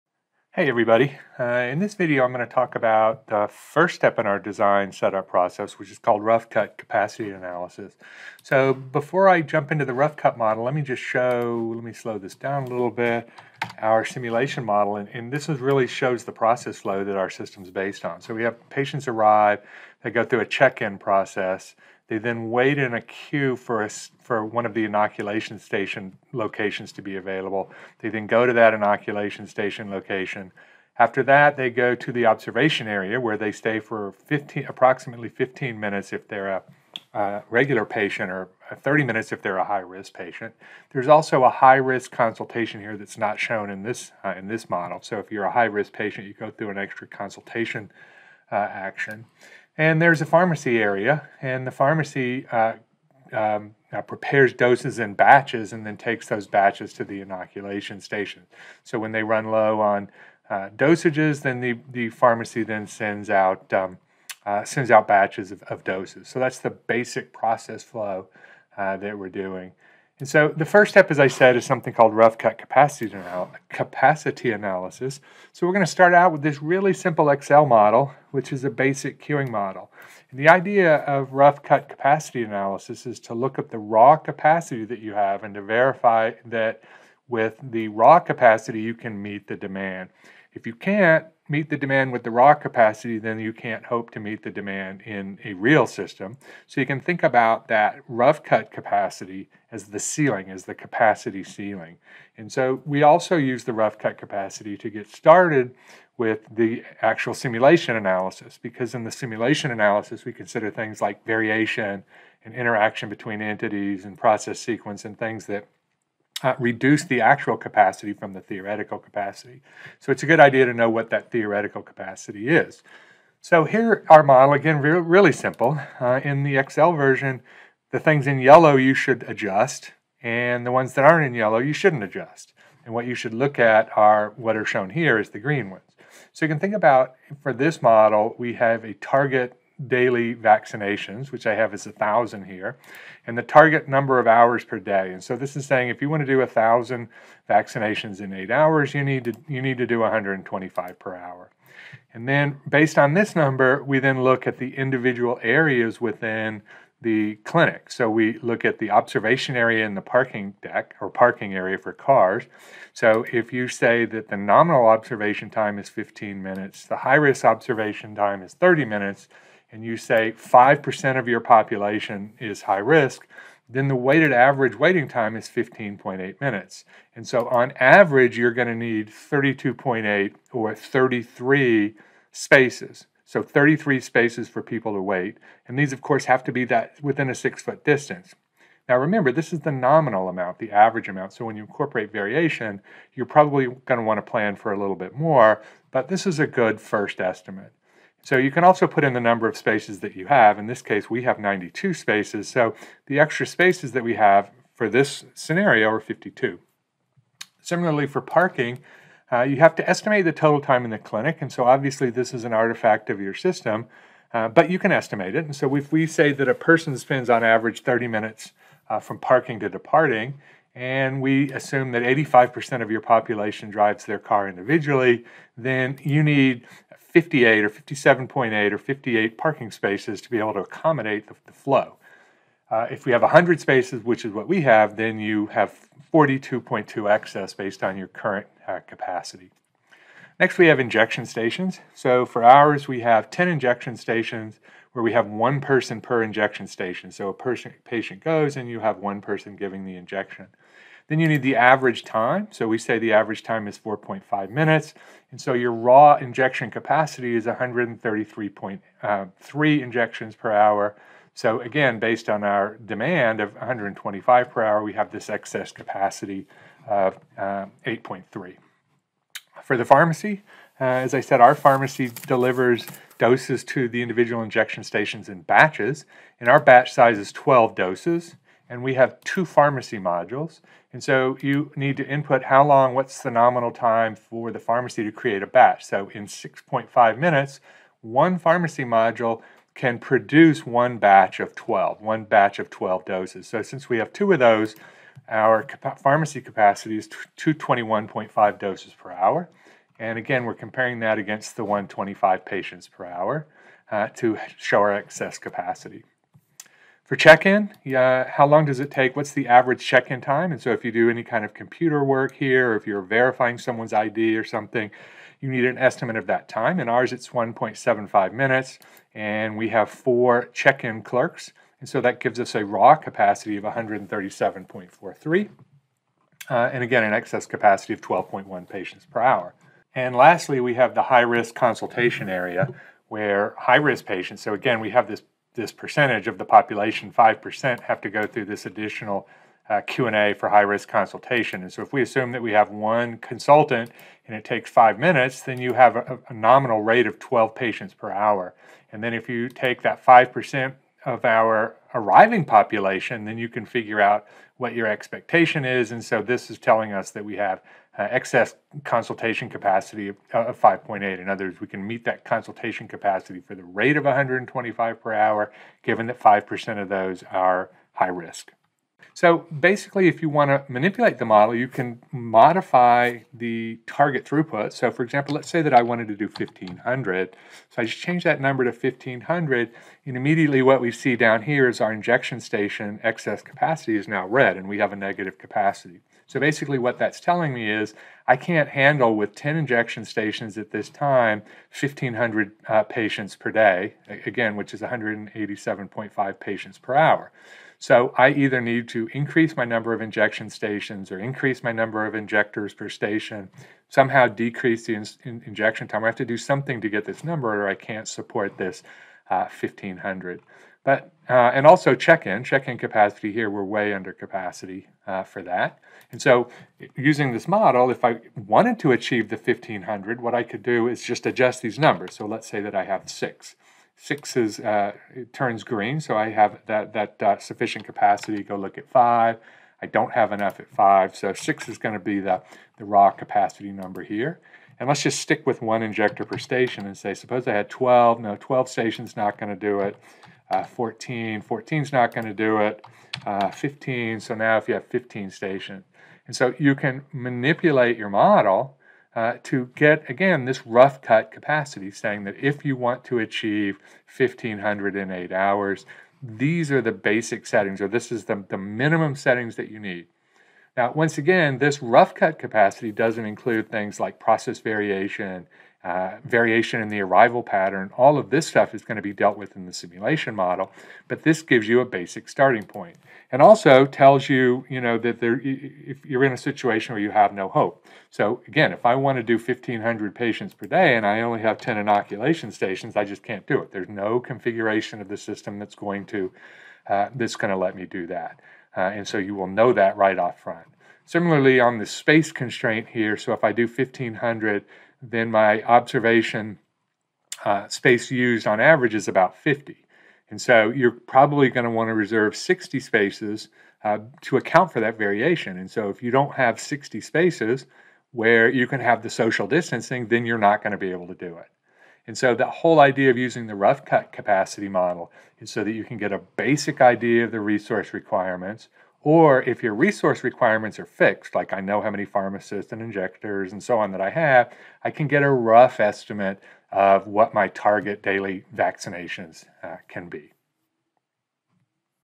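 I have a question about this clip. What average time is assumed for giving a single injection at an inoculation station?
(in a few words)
4.5 minutes.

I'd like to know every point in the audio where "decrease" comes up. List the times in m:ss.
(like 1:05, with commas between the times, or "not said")
6:44.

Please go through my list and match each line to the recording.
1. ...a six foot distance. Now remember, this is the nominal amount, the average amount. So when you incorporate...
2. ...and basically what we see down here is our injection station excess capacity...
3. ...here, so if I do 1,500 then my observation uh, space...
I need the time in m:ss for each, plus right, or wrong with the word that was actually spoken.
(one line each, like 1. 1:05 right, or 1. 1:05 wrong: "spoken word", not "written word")
1. 3:07 right
2. 6:20 wrong: "immediately", not "basically"
3. 8:12 right.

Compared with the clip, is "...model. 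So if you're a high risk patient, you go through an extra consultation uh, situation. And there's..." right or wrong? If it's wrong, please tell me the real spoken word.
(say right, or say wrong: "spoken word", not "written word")
wrong: "action", not "situation".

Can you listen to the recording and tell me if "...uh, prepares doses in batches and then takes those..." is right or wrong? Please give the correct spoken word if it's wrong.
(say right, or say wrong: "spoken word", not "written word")
right.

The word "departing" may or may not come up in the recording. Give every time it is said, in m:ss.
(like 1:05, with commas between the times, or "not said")
3:39.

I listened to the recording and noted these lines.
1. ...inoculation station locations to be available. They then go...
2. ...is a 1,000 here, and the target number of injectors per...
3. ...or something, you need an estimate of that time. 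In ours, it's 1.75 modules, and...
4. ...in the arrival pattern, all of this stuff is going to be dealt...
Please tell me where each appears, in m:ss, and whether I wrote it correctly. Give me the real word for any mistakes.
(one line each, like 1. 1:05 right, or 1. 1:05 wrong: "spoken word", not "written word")
1. 0:24 right
2. 2:21 wrong: "hours", not "injectors"
3. 5:14 wrong: "minutes", not "modules"
4. 7:46 right.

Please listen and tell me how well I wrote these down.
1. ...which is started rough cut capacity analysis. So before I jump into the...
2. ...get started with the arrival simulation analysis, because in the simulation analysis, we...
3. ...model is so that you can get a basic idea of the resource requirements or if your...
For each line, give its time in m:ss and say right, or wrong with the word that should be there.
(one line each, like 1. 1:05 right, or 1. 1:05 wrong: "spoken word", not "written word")
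1. 0:05 wrong: "called", not "started"
2. 1:44 wrong: "actual", not "arrival"
3. 8:34 right.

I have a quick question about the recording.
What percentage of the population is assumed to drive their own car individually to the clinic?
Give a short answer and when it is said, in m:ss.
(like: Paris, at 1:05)
85%, at 3:42.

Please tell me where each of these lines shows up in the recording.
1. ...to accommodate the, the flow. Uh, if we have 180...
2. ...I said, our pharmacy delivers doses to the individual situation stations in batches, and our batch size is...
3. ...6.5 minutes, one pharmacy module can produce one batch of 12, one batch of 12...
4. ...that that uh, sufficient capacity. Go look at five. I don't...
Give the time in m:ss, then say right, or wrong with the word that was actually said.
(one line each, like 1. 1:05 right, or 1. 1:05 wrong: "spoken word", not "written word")
1. 3:50 wrong: "100", not "180"
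2. 4:31 wrong: "injection", not "situation"
3. 4:46 right
4. 7:06 right.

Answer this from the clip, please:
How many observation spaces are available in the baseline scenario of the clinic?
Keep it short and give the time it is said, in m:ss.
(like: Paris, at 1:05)
92, at 3:21.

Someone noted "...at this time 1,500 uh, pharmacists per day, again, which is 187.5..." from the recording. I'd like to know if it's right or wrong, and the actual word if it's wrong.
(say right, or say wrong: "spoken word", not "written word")
wrong: "patients", not "pharmacists".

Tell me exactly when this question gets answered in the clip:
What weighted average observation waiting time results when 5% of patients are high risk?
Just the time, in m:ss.
2:55.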